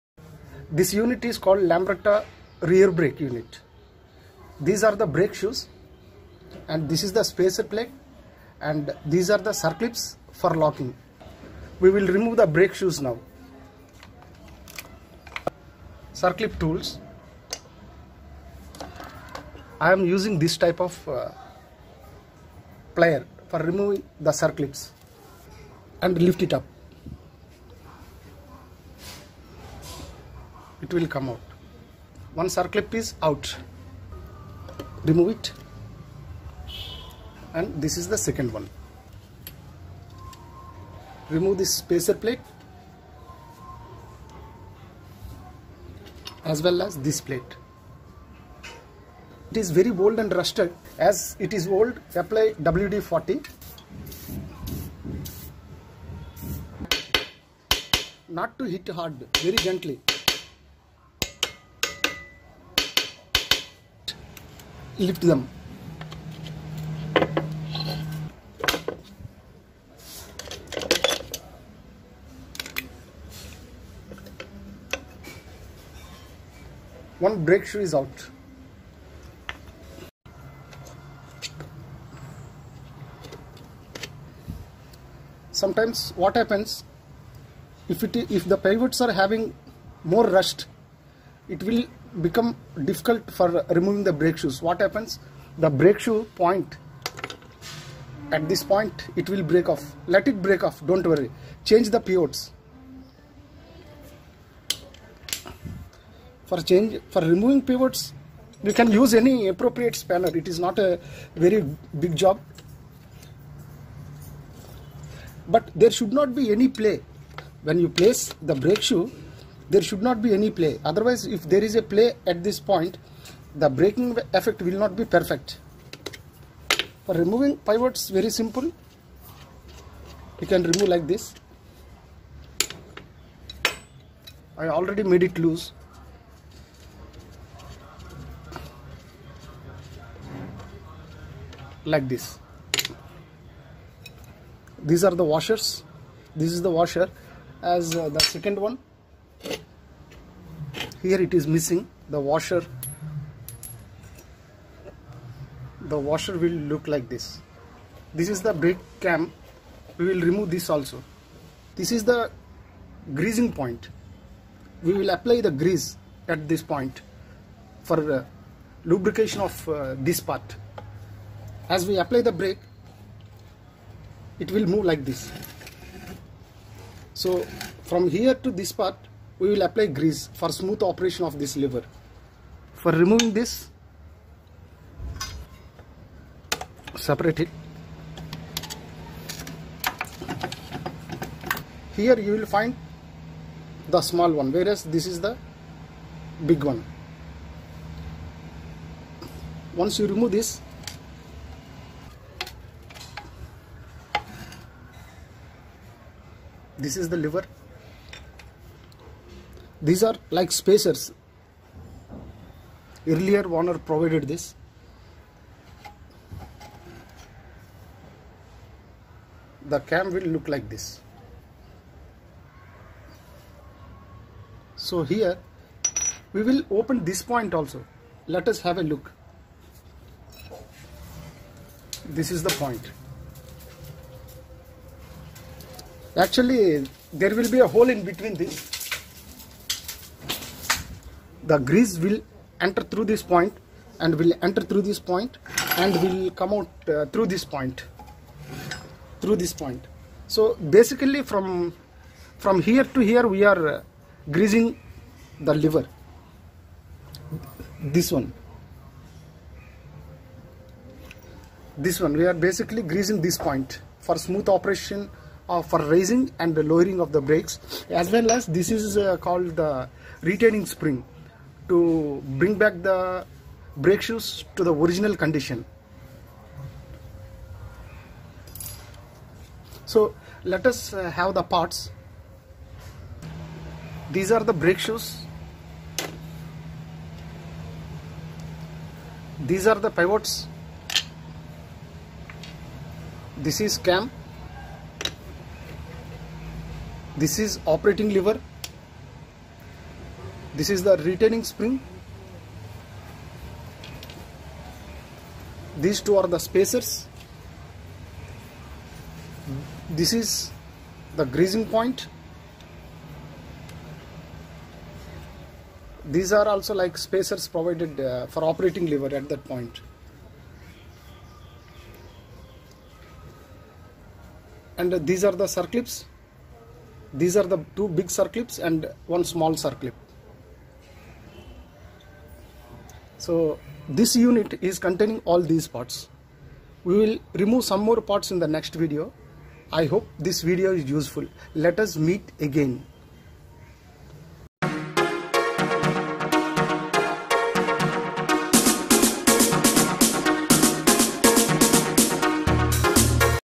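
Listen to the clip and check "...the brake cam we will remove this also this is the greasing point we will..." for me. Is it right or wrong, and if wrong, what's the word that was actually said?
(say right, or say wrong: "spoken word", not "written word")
right.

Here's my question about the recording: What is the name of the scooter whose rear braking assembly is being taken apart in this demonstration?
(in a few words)
Lambretta.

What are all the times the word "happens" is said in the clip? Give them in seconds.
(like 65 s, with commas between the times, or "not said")
86 s, 94 s.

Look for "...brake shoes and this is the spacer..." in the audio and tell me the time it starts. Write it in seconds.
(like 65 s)
5 s.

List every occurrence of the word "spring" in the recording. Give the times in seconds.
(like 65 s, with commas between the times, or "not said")
270 s, 301 s.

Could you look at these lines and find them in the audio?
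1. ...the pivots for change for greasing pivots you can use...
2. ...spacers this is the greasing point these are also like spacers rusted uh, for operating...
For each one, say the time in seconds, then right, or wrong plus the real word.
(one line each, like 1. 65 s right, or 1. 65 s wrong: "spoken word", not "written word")
1. 101 s wrong: "removing", not "greasing"
2. 306 s wrong: "provided", not "rusted".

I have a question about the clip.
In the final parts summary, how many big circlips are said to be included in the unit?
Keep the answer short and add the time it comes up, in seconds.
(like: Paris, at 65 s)
2, at 327 s.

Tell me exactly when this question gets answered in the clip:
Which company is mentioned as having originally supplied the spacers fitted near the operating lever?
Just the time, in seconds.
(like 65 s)
213 s.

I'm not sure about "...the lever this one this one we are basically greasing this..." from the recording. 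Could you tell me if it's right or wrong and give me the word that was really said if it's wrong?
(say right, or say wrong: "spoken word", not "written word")
right.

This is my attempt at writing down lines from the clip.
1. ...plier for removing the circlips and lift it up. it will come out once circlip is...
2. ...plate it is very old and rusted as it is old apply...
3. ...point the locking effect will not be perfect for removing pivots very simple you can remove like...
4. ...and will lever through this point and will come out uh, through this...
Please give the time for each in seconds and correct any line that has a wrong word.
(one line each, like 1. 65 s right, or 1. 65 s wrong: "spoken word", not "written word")
1. 22 s right
2. 47 s right
3. 122 s wrong: "braking", not "locking"
4. 243 s wrong: "enter", not "lever".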